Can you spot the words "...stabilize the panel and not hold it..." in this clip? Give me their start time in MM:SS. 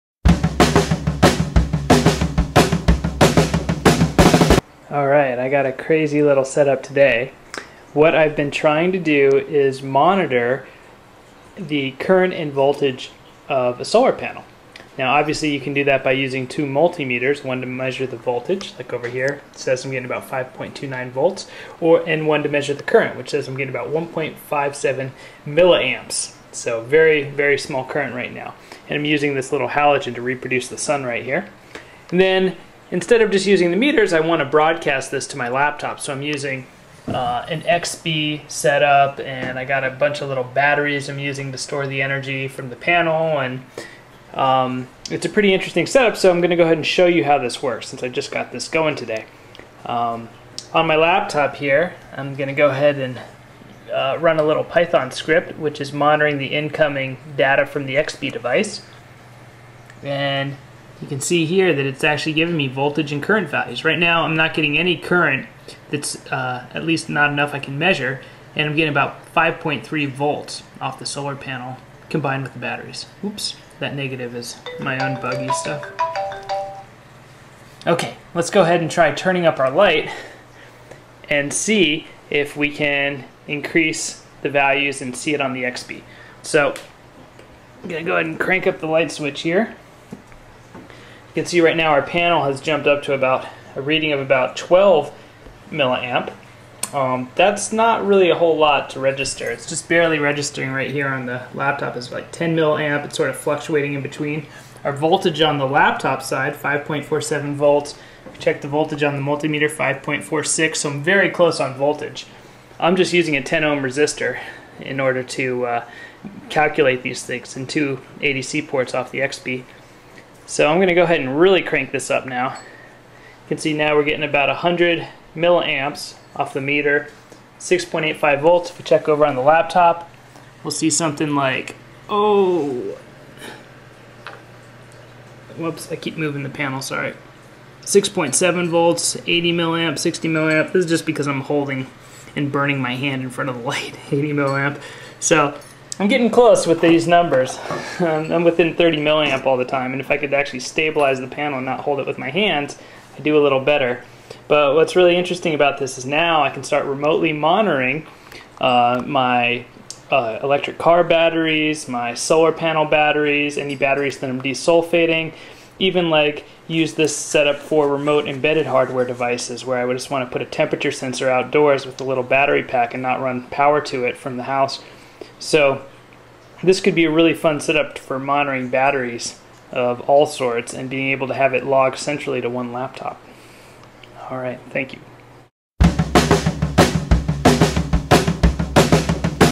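02:30.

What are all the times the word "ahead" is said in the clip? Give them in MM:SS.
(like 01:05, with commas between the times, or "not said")
00:46, 00:52, 01:18, 01:28, 02:01.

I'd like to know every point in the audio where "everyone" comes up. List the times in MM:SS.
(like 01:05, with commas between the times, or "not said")
not said.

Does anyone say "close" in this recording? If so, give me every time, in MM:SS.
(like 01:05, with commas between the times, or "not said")
01:51, 02:26.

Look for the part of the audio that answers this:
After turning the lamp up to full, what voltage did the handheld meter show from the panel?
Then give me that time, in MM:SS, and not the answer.
02:07.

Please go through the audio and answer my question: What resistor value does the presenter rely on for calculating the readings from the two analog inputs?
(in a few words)
10 ohm.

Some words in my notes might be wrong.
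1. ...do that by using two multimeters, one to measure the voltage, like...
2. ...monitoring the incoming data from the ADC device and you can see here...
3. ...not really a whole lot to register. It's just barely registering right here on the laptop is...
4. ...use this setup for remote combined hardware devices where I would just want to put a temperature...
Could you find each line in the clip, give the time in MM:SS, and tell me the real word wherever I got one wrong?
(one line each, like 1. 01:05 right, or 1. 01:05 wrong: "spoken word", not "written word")
1. 00:15 right
2. 00:55 wrong: "XBee", not "ADC"
3. 01:37 right
4. 02:46 wrong: "embedded", not "combined".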